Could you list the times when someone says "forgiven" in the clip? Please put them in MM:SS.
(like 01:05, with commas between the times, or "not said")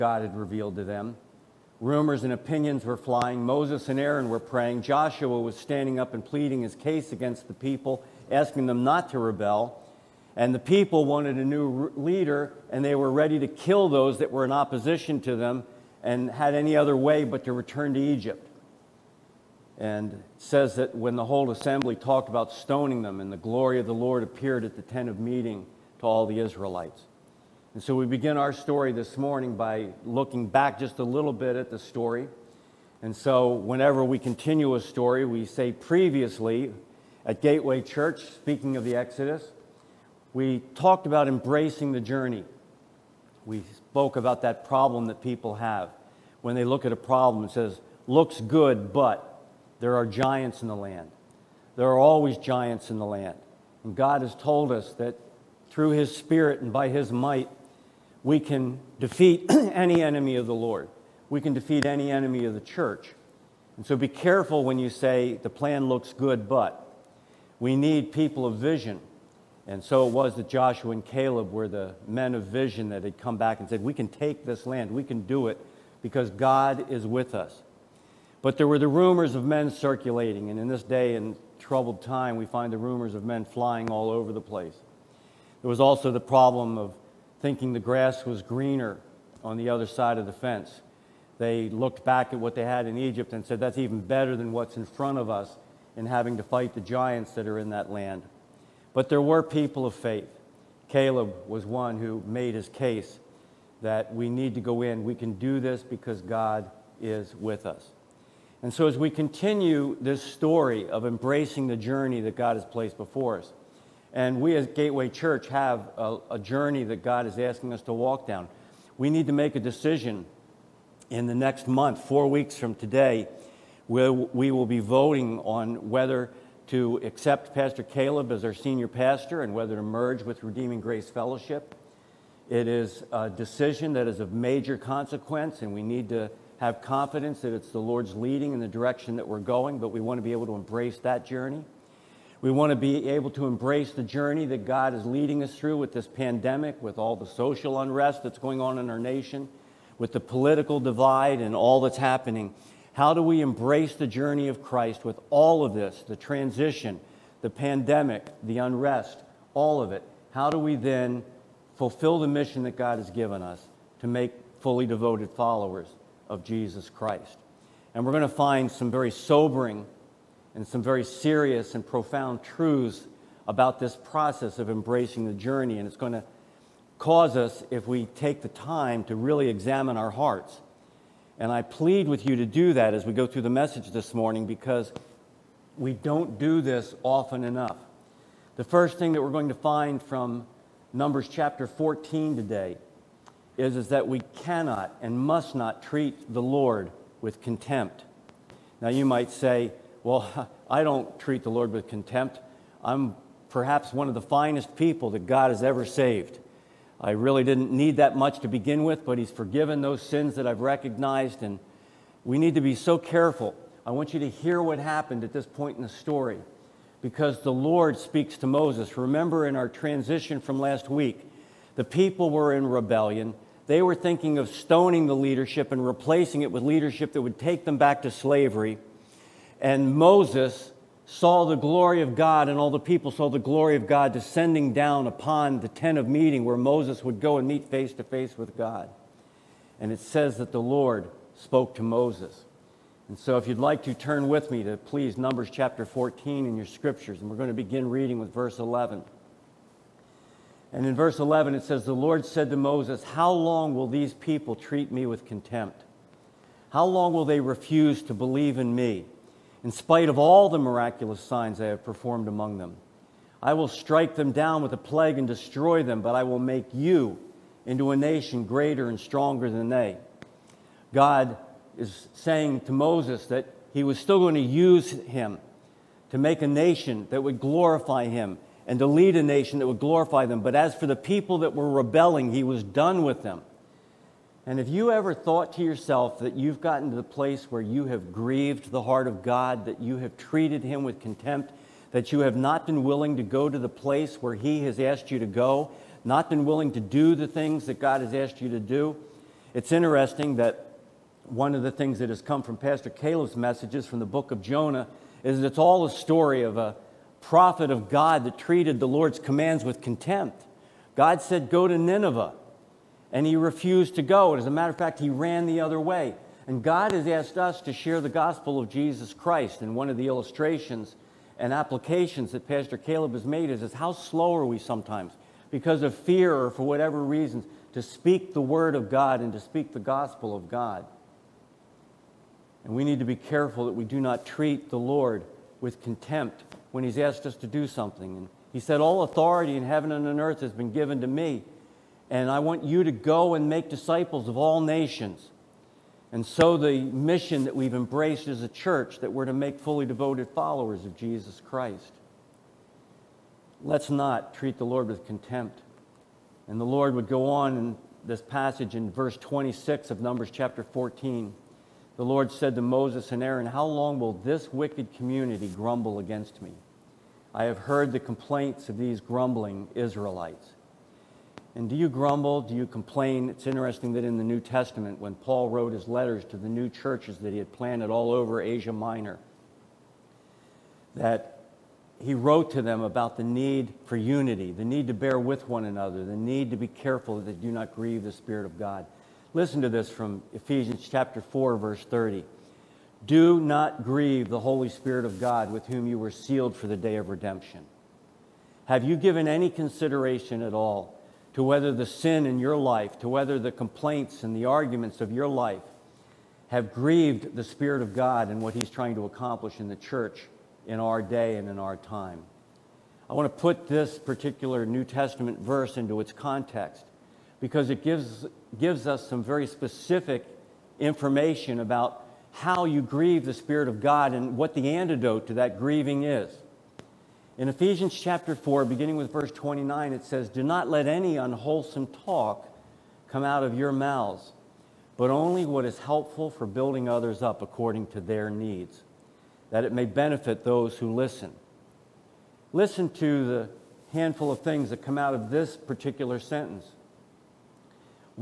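03:29.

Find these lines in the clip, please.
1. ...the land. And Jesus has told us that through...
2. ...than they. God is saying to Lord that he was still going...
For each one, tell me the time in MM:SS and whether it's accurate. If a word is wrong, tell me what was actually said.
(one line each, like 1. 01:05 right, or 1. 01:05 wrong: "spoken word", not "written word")
1. 00:53 wrong: "God", not "Jesus"
2. 04:29 wrong: "Moses", not "Lord".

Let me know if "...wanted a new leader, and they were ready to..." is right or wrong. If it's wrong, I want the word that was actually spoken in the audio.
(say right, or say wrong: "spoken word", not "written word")
right.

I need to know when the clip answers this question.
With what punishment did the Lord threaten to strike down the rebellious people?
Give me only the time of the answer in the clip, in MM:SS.
04:24.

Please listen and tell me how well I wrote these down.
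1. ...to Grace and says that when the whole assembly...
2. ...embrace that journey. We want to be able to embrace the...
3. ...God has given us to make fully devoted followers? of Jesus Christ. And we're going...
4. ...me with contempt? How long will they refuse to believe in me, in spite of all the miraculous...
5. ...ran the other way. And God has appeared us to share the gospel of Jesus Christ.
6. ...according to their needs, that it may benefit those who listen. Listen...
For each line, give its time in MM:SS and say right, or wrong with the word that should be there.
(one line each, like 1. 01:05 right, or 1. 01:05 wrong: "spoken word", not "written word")
1. 00:17 wrong: "Egypt", not "Grace"
2. 02:20 right
3. 02:42 right
4. 04:14 right
5. 05:15 wrong: "asked", not "appeared"
6. 07:17 right.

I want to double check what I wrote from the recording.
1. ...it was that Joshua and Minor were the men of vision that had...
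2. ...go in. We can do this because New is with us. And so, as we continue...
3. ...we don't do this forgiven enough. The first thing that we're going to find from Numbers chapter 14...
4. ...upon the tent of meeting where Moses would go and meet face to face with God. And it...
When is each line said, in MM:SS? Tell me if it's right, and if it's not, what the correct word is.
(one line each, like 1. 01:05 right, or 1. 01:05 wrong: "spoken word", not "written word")
1. 01:10 wrong: "Caleb", not "Minor"
2. 01:44 wrong: "God", not "New"
3. 03:05 wrong: "often", not "forgiven"
4. 03:55 right.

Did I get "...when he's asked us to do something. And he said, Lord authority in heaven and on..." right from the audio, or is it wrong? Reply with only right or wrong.
wrong.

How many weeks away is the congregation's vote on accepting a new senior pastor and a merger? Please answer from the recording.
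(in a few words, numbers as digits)
4.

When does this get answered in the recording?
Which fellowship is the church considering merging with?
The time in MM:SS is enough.
02:10.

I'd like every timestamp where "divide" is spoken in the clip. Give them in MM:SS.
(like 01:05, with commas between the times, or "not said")
02:30.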